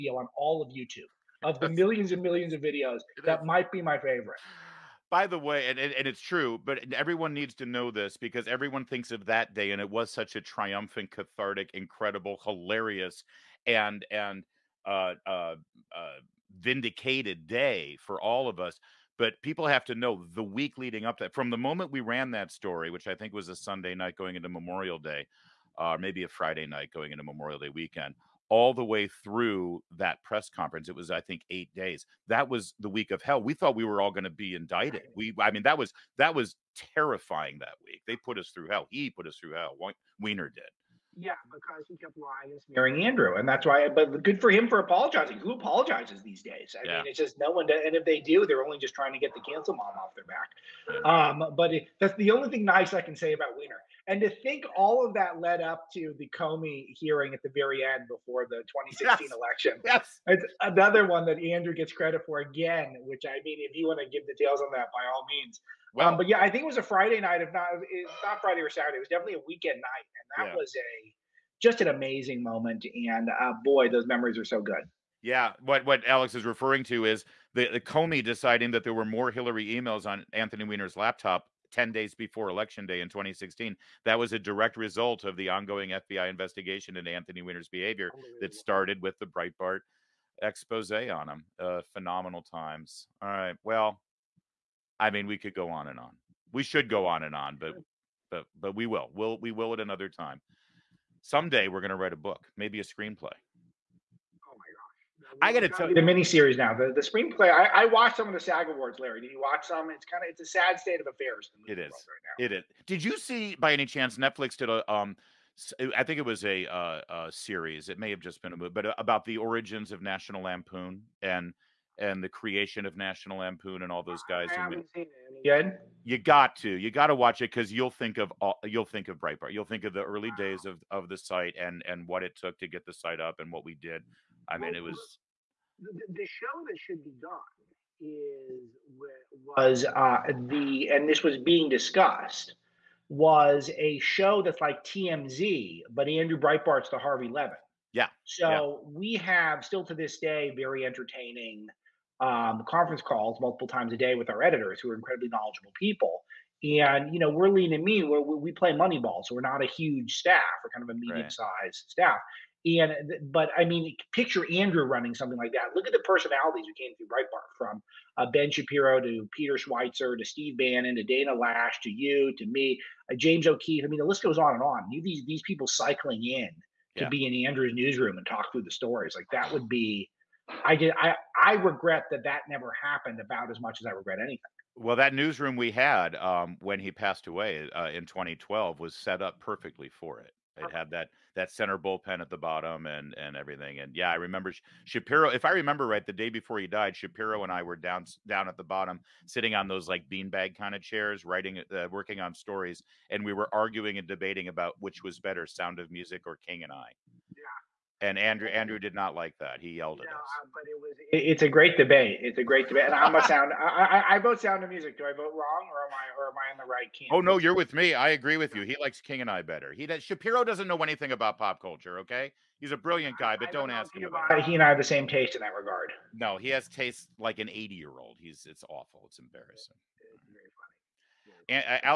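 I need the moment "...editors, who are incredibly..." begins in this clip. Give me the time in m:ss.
2:34.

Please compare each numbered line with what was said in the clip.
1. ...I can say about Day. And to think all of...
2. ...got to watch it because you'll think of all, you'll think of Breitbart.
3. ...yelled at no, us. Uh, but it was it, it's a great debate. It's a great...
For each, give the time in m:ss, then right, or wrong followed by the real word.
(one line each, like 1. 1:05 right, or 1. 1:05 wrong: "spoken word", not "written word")
1. 0:52 wrong: "Weiner", not "Day"
2. 2:06 right
3. 3:29 right.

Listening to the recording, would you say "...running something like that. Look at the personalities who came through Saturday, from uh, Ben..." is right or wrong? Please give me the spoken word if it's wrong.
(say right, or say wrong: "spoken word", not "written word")
wrong: "Breitbart", not "Saturday".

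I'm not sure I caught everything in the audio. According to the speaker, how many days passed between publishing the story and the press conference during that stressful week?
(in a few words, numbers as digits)
8 days.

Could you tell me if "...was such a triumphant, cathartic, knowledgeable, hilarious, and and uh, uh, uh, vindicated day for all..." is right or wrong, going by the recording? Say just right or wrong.
wrong.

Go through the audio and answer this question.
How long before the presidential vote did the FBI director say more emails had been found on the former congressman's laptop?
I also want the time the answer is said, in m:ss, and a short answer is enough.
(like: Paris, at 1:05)
10 days, at 1:21.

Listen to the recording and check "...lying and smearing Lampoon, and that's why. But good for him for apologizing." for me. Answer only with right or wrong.
wrong.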